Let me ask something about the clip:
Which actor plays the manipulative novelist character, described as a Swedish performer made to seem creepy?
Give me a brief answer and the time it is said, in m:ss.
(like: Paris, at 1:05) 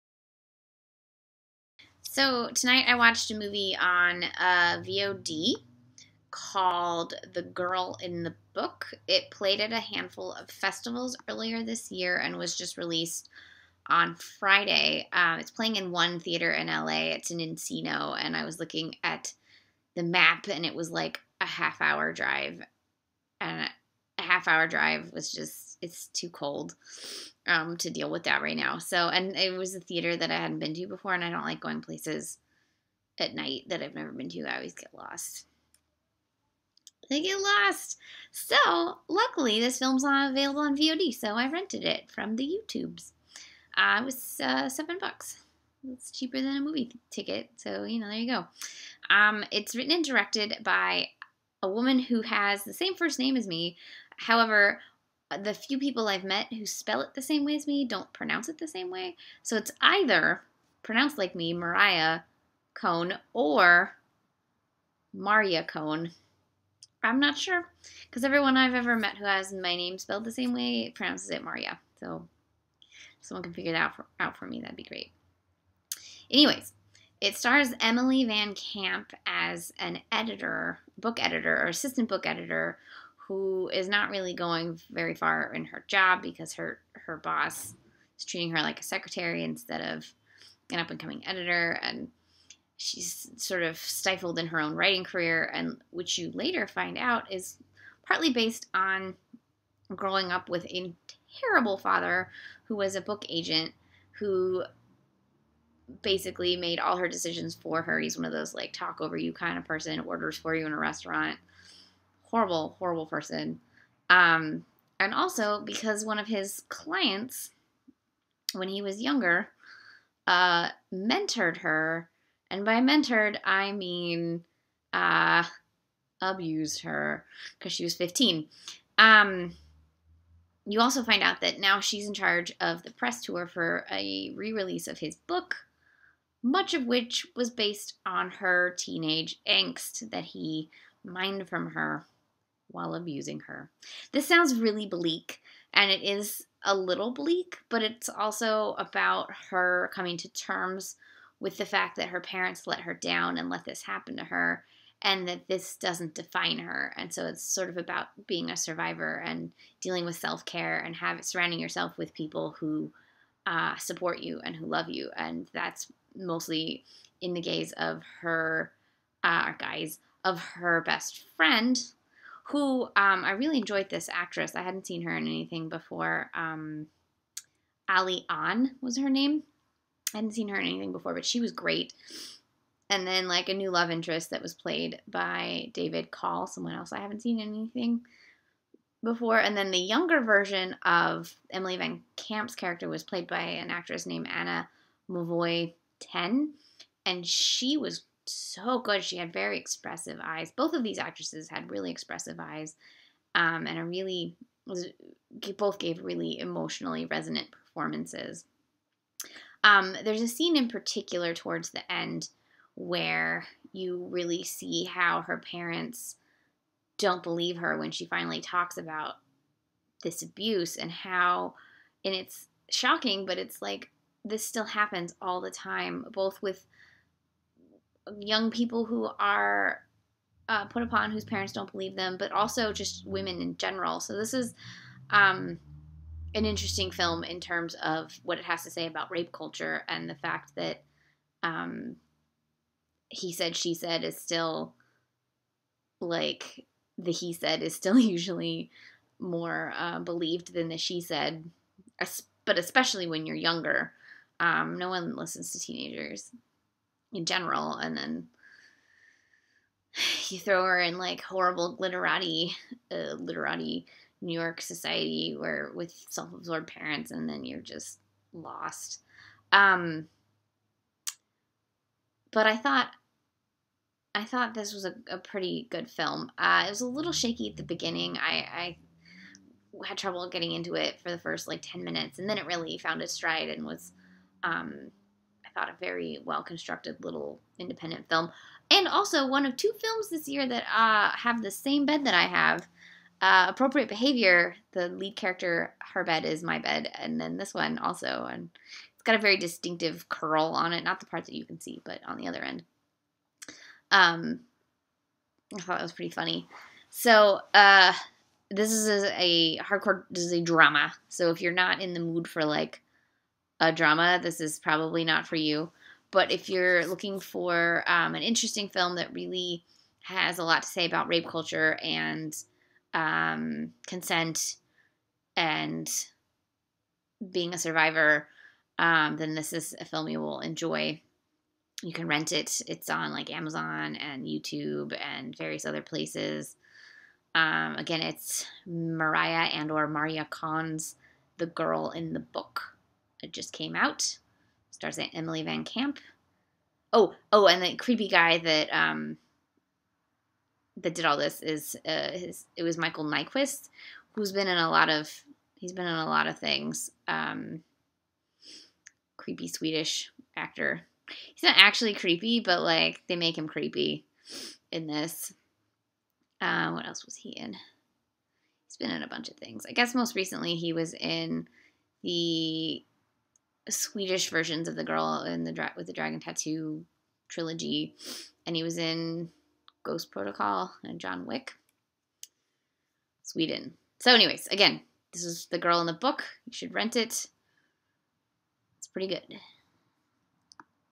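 Michael Nyqvist, at 5:52.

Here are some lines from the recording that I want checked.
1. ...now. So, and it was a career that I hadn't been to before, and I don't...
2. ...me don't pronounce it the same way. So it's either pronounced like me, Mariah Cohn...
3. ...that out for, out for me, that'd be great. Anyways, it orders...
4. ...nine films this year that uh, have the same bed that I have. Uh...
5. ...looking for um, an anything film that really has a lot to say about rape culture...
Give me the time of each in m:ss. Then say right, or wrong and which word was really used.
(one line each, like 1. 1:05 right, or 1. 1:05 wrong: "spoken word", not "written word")
1. 0:28 wrong: "theater", not "career"
2. 0:57 right
3. 1:13 wrong: "stars", not "orders"
4. 4:49 wrong: "two", not "nine"
5. 5:16 wrong: "interesting", not "anything".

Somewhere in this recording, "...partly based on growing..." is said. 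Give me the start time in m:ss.
1:38.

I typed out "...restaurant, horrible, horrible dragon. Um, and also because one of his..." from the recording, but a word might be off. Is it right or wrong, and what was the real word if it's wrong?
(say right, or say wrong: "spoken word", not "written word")
wrong: "person", not "dragon".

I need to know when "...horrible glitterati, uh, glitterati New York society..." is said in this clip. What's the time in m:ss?
4:21.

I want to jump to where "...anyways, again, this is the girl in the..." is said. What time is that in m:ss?
6:24.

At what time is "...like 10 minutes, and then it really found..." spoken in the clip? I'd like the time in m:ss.
4:41.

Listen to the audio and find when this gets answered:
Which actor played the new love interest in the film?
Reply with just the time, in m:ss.
3:05.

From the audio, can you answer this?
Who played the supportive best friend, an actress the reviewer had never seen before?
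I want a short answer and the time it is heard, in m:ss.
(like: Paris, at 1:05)
Ali Ahn, at 2:57.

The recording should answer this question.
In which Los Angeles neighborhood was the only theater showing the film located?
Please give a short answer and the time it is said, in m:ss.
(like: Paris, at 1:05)
Encino, at 0:17.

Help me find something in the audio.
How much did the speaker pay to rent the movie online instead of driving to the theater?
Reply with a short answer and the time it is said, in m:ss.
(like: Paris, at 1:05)
$7, at 0:44.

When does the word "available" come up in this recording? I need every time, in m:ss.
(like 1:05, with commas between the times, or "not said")
0:40.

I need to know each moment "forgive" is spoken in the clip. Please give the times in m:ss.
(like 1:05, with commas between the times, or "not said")
not said.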